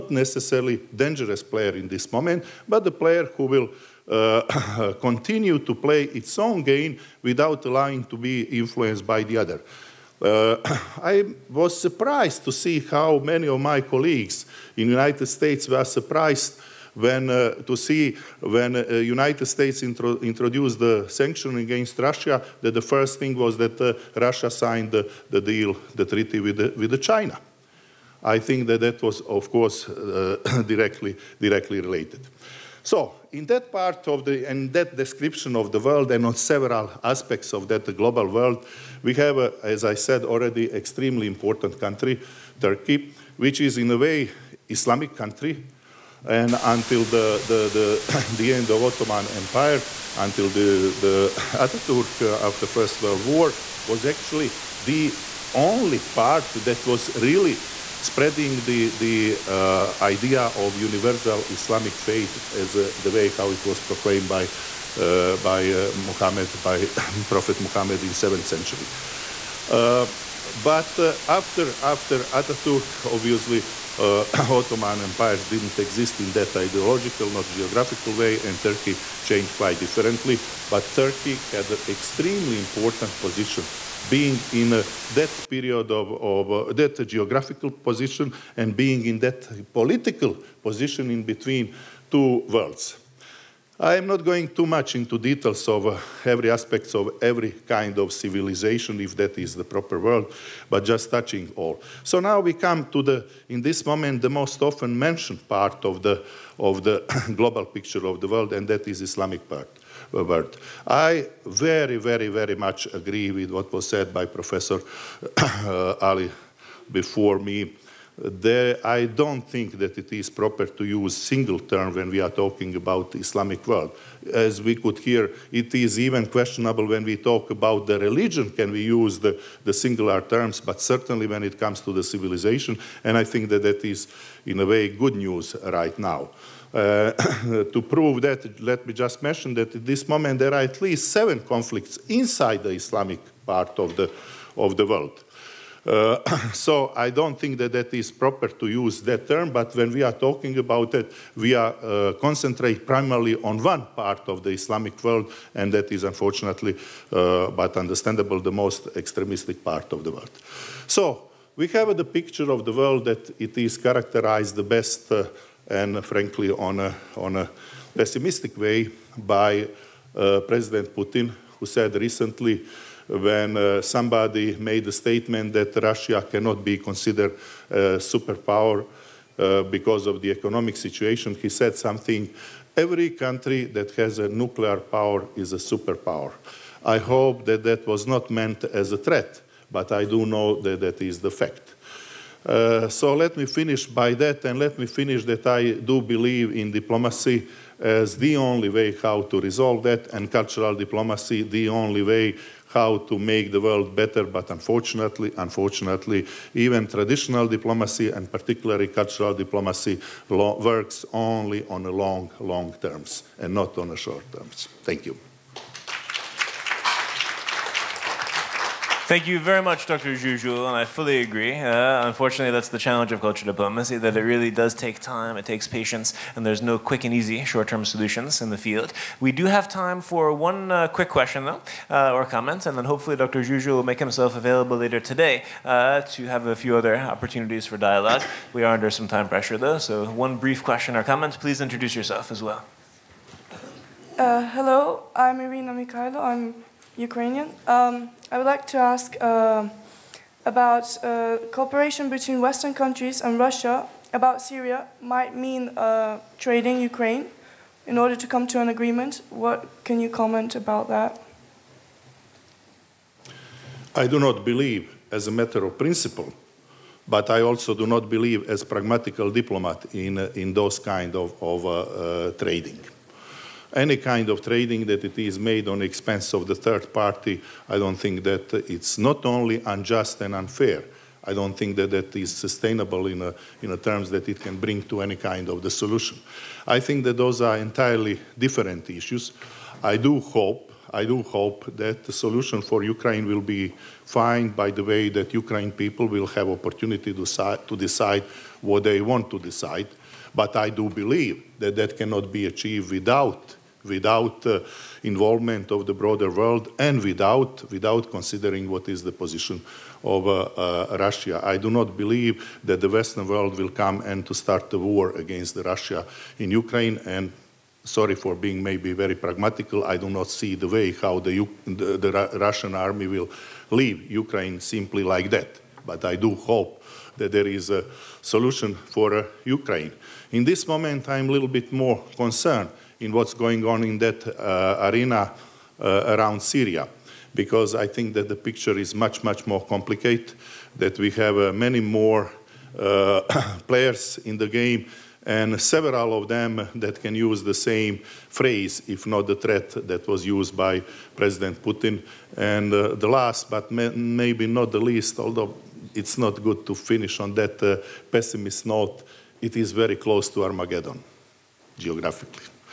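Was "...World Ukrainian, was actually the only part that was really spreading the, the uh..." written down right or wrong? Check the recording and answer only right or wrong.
wrong.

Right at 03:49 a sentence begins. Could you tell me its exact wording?
We do have time for one uh, quick question, though, uh, or comment, and then hopefully Dr.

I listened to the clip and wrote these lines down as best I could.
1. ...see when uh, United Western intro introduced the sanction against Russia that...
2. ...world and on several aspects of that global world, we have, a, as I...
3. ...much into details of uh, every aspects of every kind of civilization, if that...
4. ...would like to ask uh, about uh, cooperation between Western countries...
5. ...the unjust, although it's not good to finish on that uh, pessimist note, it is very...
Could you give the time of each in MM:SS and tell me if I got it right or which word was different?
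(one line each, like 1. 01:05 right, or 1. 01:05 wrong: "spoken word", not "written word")
1. 00:17 wrong: "States", not "Western"
2. 00:35 right
3. 01:34 right
4. 04:08 right
5. 05:54 wrong: "least", not "unjust".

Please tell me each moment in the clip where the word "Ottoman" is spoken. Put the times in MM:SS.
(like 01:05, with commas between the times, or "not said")
00:48, 01:13.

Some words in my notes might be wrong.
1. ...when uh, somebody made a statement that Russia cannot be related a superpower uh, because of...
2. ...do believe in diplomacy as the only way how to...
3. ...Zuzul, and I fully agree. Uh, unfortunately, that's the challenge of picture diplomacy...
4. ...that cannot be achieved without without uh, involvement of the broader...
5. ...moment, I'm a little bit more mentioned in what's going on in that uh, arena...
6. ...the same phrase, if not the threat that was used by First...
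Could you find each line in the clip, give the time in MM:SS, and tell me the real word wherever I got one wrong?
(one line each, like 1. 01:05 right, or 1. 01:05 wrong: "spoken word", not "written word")
1. 02:53 wrong: "considered", not "related"
2. 03:15 right
3. 03:40 wrong: "culture", not "picture"
4. 05:01 right
5. 05:30 wrong: "concerned", not "mentioned"
6. 05:47 wrong: "President", not "First".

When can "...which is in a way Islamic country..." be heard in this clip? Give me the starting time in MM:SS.
00:43.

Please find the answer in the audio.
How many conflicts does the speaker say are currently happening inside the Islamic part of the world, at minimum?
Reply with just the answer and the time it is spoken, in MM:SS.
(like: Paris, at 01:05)
7, at 02:21.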